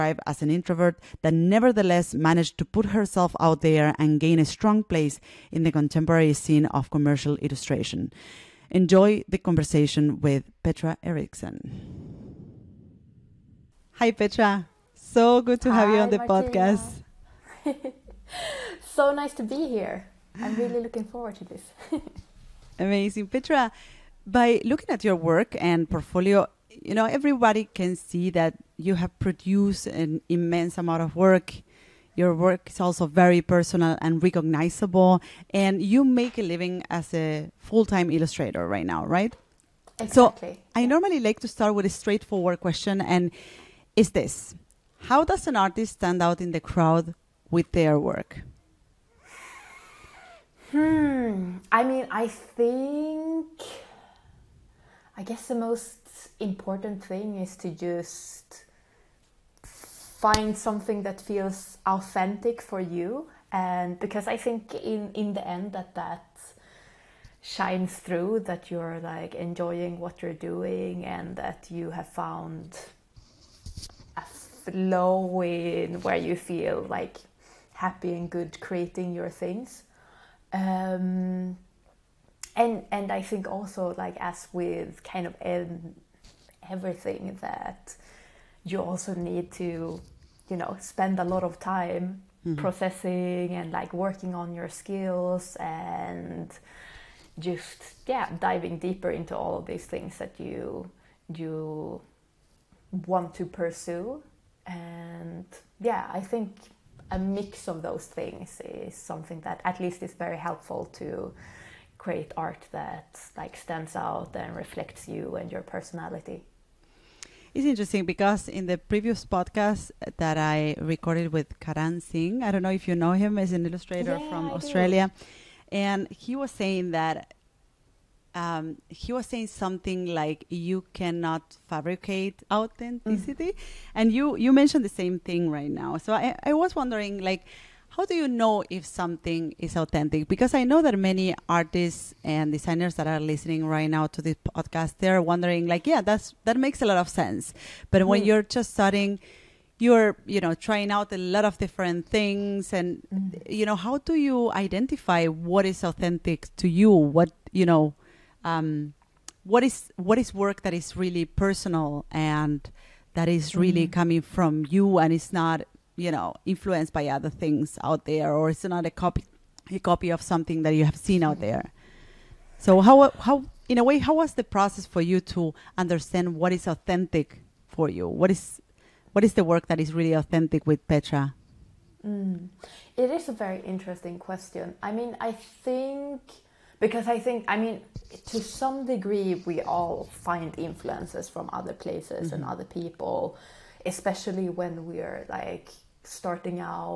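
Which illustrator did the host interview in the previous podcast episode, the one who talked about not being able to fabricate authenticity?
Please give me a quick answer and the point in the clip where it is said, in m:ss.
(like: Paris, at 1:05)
Karan Singh, at 2:01.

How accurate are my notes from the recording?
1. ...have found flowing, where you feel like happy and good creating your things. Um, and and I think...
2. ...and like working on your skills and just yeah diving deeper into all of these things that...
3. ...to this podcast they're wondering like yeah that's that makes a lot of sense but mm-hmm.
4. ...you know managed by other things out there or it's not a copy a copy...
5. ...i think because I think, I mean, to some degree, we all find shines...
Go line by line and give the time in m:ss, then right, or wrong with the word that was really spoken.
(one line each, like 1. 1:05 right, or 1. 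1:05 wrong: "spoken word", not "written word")
1. 1:11 right
2. 1:33 right
3. 2:24 right
4. 2:45 wrong: "influenced", not "managed"
5. 3:05 wrong: "influences", not "shines".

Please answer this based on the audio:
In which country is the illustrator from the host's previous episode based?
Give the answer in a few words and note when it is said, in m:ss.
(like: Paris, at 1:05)
Australia, at 2:04.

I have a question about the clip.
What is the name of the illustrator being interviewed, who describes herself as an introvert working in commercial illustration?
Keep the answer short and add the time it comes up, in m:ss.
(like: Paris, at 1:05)
Petra Eriksson, at 0:10.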